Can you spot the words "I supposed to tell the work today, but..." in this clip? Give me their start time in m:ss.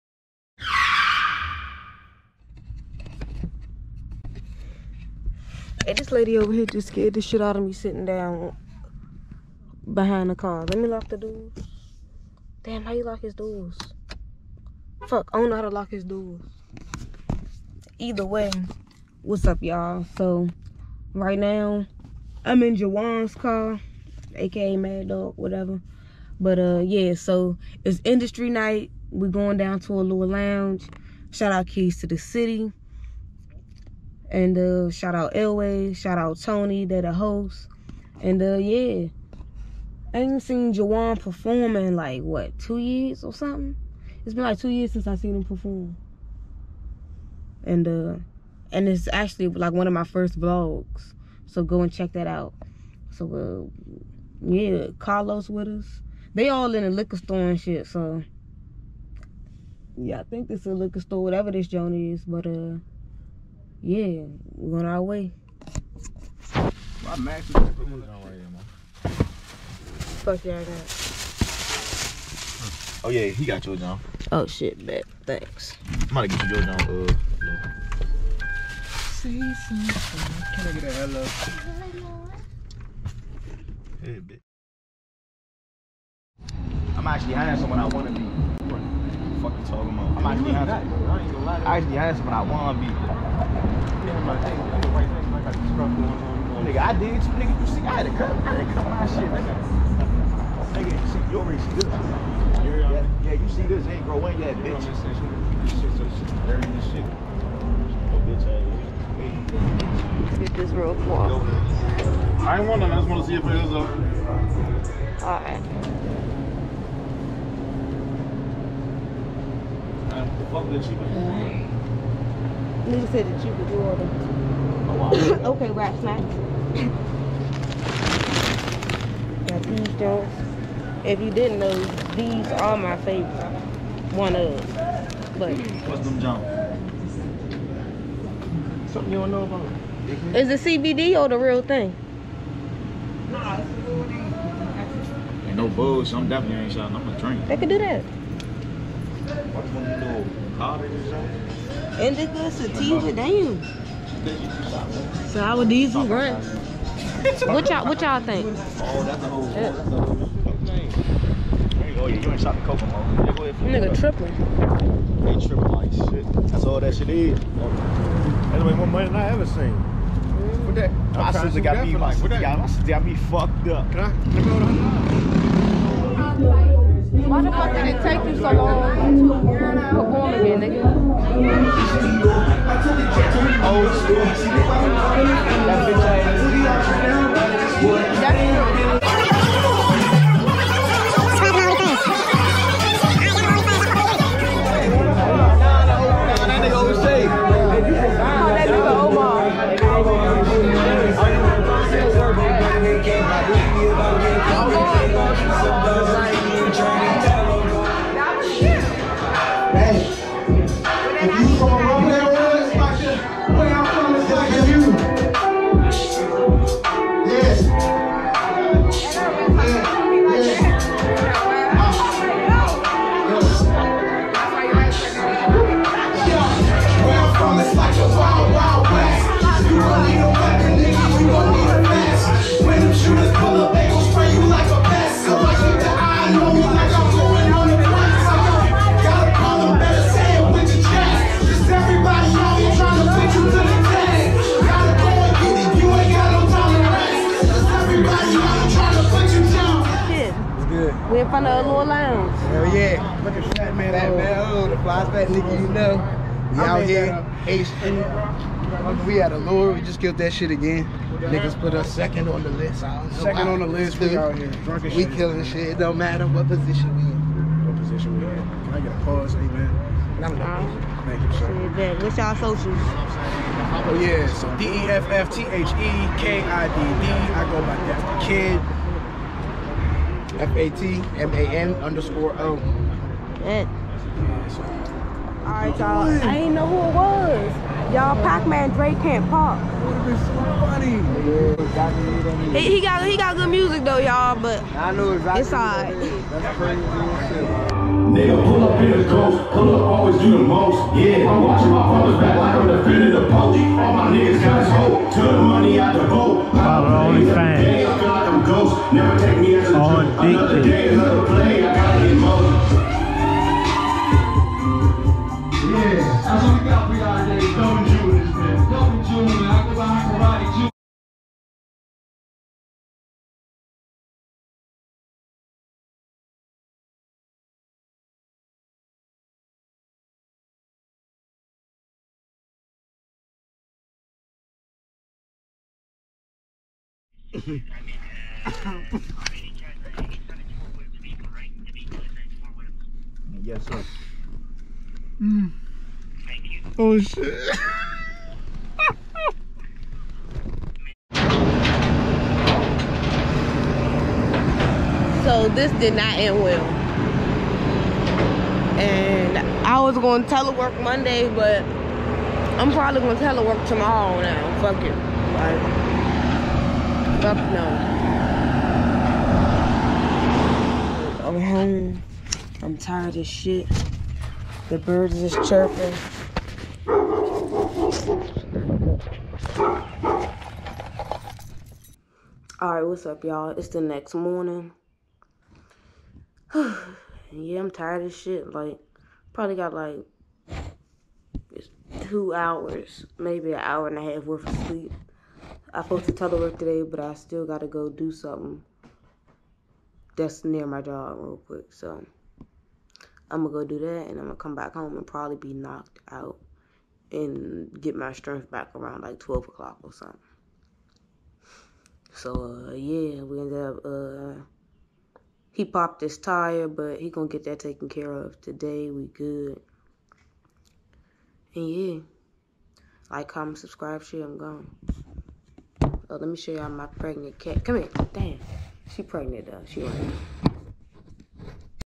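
6:35.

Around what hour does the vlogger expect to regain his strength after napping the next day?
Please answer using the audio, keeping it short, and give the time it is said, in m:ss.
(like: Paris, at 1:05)
12 o'clock, at 6:49.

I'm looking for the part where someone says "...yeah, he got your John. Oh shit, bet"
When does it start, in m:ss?
1:13.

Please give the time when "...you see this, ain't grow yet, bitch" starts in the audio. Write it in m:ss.
1:43.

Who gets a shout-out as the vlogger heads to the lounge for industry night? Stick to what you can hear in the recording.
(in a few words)
Keys to the City.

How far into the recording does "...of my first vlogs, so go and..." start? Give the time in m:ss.
0:49.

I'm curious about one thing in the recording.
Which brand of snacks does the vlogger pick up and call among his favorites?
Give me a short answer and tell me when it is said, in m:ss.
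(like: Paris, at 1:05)
Rap Snacks, at 2:05.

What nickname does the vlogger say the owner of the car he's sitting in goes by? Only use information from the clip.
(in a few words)
Mad Dog.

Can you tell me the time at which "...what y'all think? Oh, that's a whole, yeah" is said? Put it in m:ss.
2:37.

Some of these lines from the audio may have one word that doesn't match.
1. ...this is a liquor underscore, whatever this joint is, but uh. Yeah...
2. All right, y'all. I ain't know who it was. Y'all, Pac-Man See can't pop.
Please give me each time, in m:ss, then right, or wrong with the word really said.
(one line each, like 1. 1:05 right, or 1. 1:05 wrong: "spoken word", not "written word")
1. 1:00 wrong: "store", not "underscore"
2. 4:44 wrong: "Drake", not "See".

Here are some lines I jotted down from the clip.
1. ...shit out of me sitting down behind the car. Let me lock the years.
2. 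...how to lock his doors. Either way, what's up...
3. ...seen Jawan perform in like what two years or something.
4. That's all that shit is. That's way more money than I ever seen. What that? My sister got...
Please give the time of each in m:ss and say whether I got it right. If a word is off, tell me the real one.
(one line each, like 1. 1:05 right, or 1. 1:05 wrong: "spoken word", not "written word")
1. 0:07 wrong: "doors", not "years"
2. 0:15 right
3. 0:40 right
4. 2:46 right.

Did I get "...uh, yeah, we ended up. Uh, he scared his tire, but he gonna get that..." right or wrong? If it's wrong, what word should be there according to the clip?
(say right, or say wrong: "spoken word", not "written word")
wrong: "popped", not "scared".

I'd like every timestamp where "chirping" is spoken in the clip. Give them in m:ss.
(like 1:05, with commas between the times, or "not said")
6:15.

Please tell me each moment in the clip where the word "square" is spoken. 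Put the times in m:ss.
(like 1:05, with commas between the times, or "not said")
not said.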